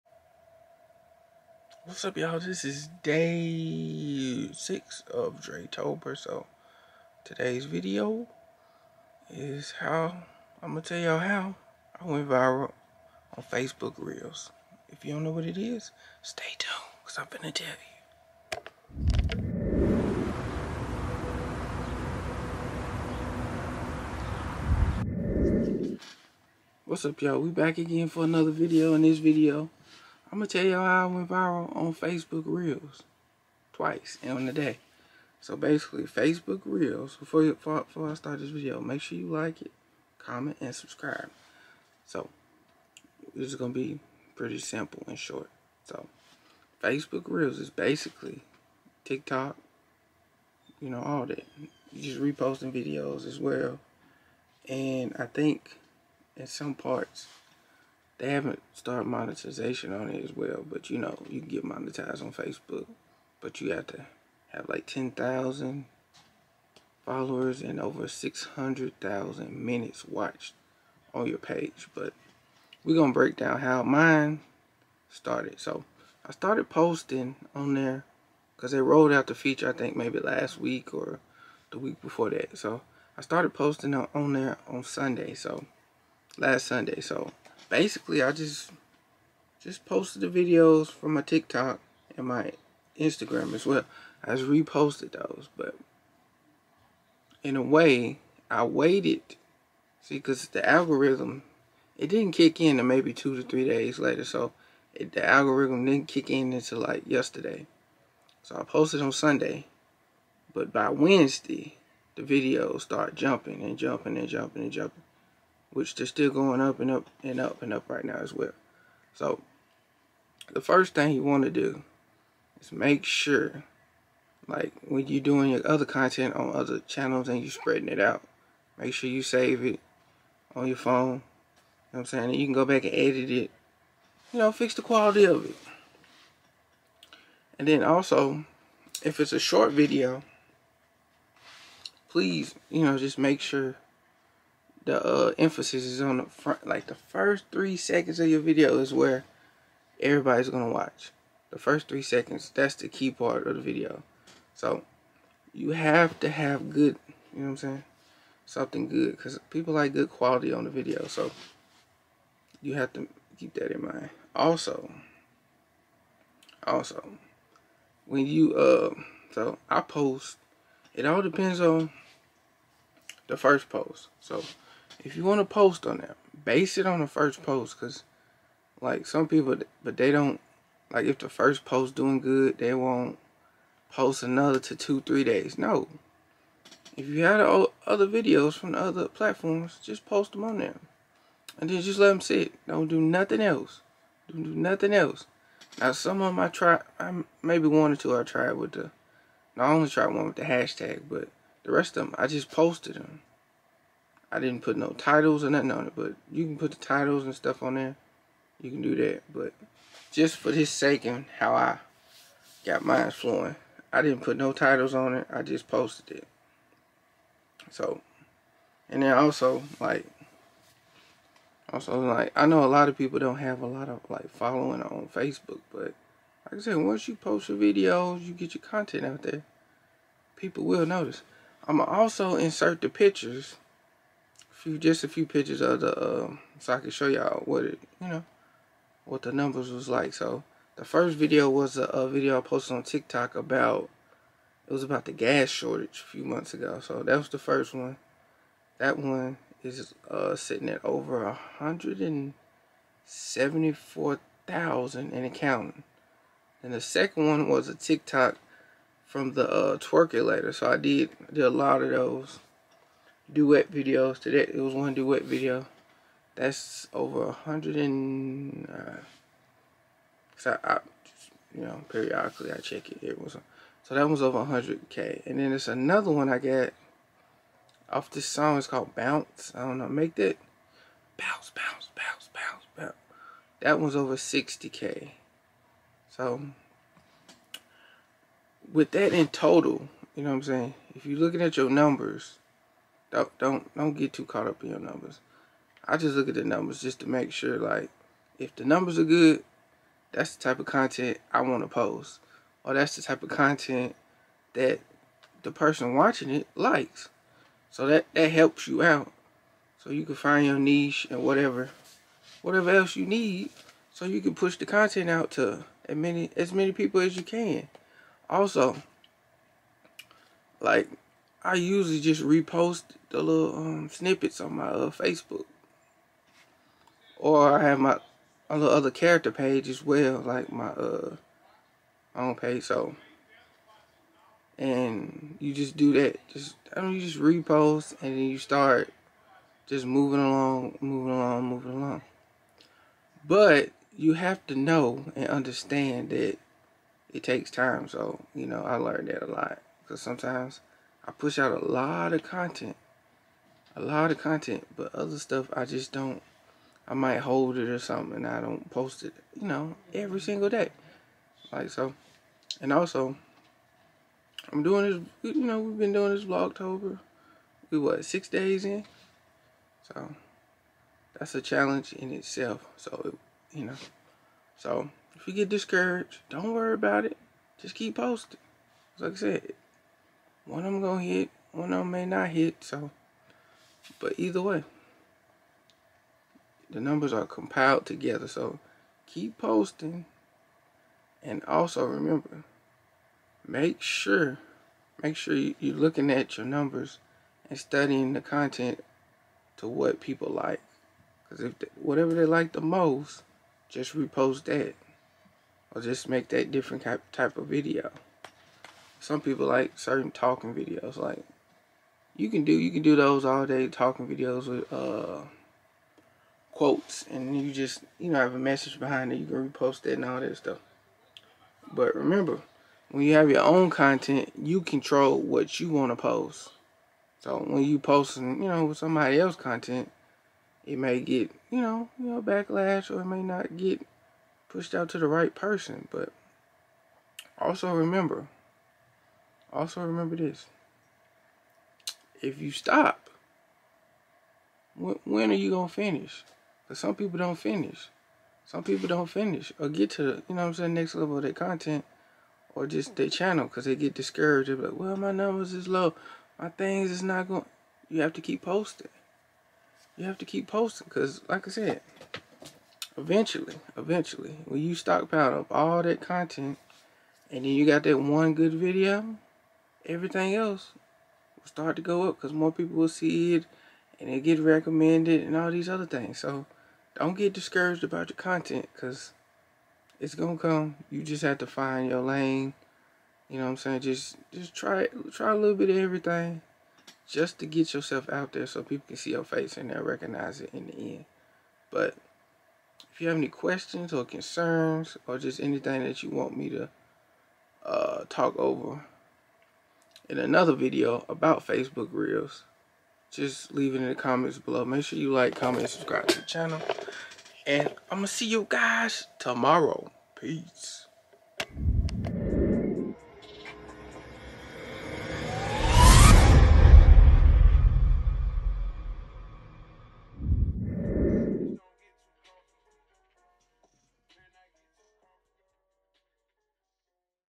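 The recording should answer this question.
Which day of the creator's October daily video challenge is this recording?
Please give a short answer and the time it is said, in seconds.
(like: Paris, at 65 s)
Day 6, at 3 s.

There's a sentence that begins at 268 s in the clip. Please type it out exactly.
Uh, Cause I, I just, you know, periodically I check it.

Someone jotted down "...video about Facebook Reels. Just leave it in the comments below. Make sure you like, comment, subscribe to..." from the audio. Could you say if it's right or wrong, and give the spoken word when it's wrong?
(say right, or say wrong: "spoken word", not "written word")
right.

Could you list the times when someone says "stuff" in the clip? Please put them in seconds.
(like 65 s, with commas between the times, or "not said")
207 s, 355 s, 420 s.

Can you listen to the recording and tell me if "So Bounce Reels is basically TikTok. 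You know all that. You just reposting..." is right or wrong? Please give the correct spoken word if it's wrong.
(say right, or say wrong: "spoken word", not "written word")
wrong: "Facebook", not "Bounce".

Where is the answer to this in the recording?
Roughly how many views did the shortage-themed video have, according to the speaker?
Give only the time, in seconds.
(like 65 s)
250 s.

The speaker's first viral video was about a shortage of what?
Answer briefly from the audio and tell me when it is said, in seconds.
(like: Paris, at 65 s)
Gas, at 245 s.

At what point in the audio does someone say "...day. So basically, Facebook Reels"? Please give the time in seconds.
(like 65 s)
34 s.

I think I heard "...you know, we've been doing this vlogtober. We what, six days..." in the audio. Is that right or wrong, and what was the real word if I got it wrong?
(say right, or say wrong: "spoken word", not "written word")
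right.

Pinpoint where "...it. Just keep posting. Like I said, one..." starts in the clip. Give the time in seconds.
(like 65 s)
377 s.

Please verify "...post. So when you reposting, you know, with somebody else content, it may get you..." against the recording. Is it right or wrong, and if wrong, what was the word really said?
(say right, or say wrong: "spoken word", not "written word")
wrong: "posting", not "reposting".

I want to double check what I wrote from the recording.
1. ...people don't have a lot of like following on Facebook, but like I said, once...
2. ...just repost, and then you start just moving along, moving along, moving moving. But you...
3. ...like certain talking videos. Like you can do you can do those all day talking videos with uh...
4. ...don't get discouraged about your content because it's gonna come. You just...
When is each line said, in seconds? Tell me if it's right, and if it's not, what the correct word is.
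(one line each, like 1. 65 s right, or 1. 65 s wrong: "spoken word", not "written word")
1. 222 s right
2. 337 s wrong: "along", not "moving"
3. 409 s right
4. 476 s right.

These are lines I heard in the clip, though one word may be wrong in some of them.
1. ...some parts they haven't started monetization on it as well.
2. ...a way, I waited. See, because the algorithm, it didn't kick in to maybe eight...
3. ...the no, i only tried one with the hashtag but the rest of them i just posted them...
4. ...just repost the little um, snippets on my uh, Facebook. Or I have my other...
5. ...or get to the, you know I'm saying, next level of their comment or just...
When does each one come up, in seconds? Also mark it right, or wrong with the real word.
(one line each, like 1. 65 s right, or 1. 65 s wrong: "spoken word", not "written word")
1. 56 s right
2. 97 s wrong: "two", not "eight"
3. 198 s right
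4. 321 s right
5. 449 s wrong: "content", not "comment".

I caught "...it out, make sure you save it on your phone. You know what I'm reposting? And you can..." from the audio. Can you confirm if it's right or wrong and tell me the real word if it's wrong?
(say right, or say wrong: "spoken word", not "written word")
wrong: "saying", not "reposting".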